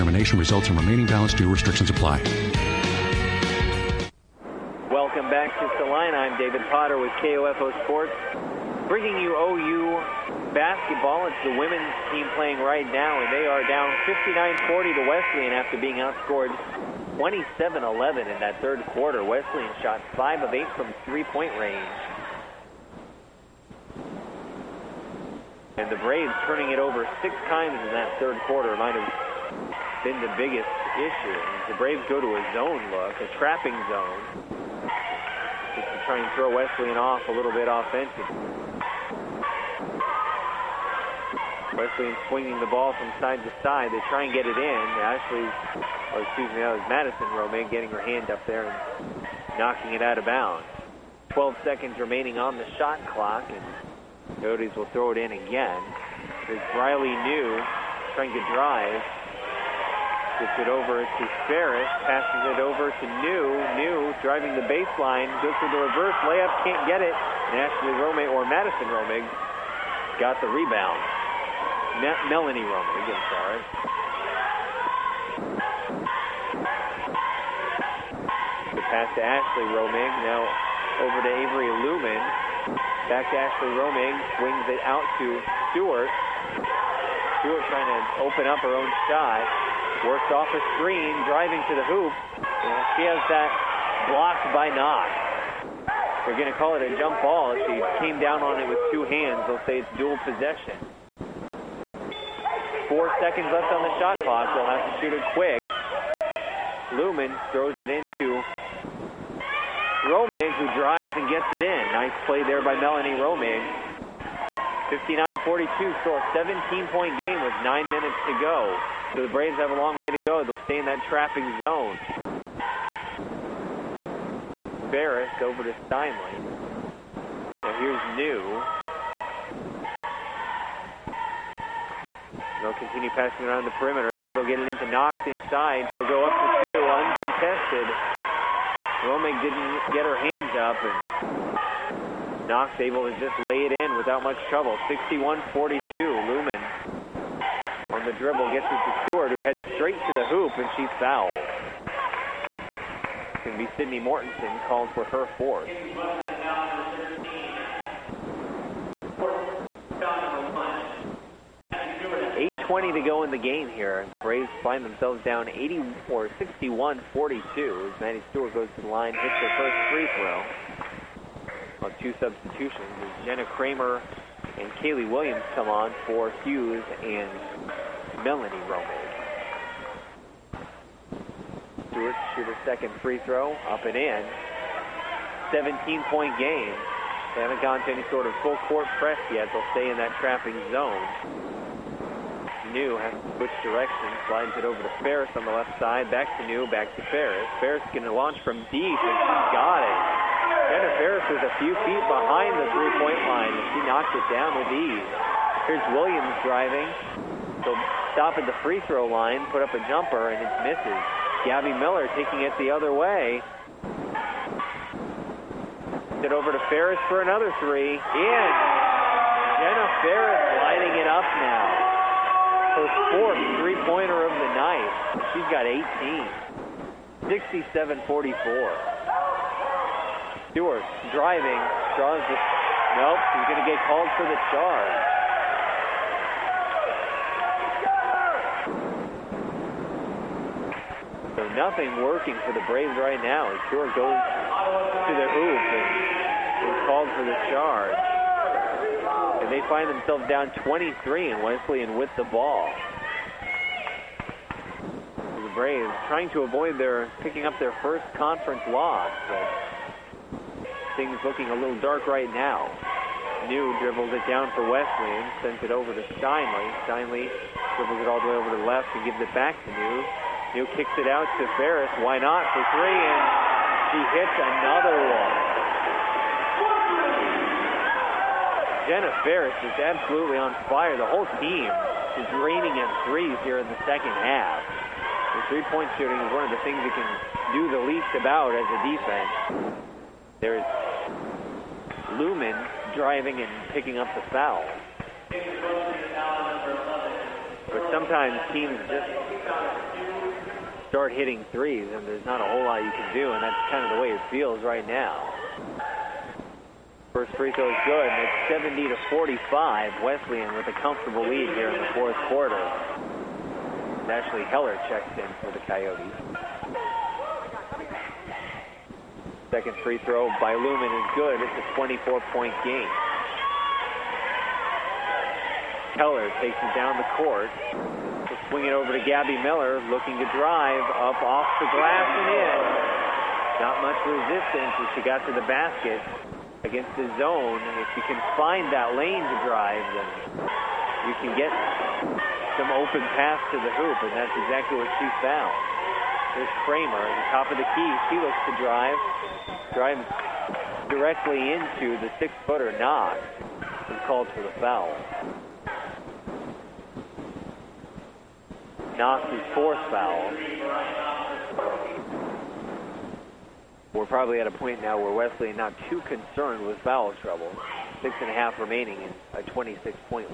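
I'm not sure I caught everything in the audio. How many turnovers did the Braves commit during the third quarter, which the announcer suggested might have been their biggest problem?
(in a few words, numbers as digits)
6.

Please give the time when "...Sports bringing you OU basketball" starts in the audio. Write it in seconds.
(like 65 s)
7 s.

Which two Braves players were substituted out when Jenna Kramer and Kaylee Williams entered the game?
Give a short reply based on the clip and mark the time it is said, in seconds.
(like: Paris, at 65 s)
Hughes and Melanie Romig, at 176 s.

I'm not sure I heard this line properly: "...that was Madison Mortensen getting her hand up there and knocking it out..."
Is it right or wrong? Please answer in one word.
wrong.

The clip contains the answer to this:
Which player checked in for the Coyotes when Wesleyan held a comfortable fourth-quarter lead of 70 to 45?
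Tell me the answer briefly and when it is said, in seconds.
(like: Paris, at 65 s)
Ashley Heller, at 314 s.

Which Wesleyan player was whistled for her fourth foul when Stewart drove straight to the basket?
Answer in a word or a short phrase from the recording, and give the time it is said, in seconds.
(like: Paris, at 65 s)
Sydney Mortensen, at 153 s.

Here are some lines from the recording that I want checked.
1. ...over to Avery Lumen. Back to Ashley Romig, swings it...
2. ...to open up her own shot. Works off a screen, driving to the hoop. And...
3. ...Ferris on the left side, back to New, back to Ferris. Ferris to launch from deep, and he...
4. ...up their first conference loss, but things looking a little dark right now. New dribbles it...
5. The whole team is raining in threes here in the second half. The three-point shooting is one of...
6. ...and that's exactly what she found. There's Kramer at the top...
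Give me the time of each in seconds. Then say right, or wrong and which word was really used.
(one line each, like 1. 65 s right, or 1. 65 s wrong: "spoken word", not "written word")
1. 81 s right
2. 87 s right
3. 194 s right
4. 257 s right
5. 280 s right
6. 344 s right.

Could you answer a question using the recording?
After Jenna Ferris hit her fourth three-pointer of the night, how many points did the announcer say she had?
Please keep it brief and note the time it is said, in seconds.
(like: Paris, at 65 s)
18, at 225 s.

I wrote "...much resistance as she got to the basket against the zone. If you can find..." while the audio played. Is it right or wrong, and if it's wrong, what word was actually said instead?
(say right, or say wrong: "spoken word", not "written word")
right.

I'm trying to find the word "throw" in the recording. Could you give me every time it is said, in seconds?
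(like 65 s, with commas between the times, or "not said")
36 s, 54 s, 107 s, 170 s, 183 s, 208 s, 307 s, 320 s.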